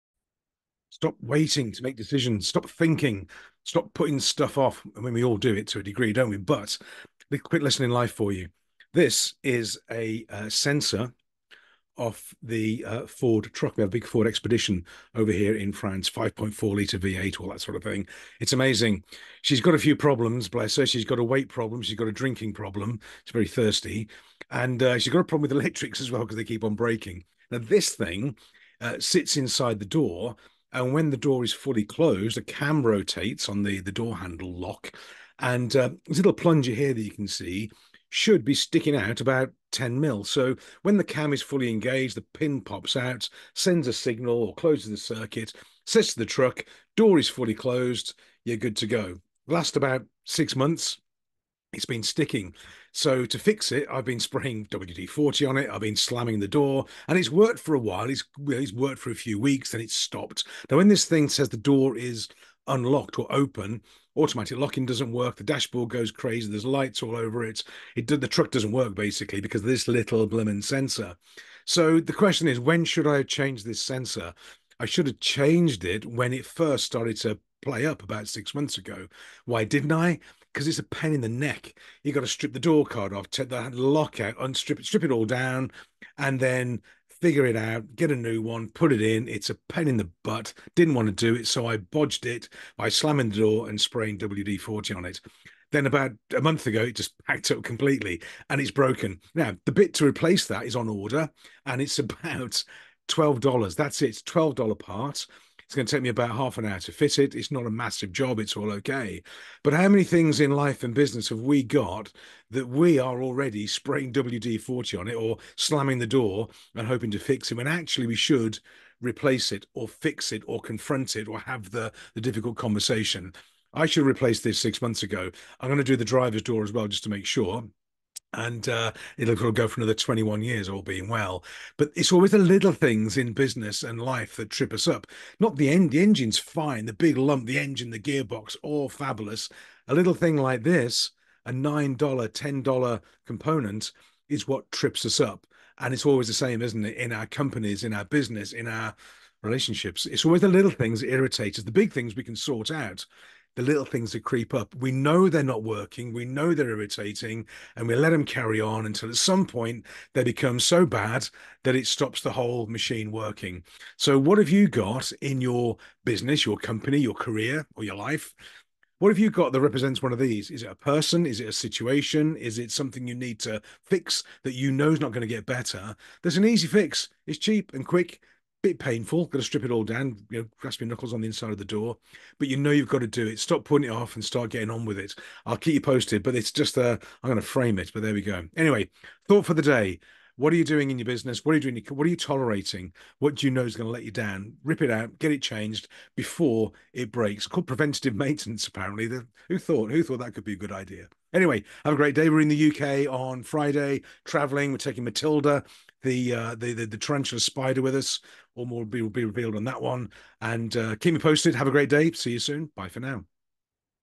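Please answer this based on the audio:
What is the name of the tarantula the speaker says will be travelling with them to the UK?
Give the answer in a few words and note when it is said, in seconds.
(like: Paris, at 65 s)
Matilda, at 205 s.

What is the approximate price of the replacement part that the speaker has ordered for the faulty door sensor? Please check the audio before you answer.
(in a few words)
$12.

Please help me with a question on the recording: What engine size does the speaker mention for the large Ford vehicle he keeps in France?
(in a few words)
5.4 litre V8.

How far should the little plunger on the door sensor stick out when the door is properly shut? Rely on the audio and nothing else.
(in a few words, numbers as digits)
10 mil.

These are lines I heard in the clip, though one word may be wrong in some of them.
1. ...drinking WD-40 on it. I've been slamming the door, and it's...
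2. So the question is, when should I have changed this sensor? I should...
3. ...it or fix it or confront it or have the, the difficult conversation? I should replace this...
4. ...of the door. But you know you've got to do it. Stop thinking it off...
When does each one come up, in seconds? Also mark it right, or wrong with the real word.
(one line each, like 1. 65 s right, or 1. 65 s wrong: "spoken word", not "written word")
1. 54 s wrong: "spraying", not "drinking"
2. 71 s right
3. 119 s right
4. 181 s wrong: "putting", not "thinking".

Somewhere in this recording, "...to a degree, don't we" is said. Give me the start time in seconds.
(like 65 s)
5 s.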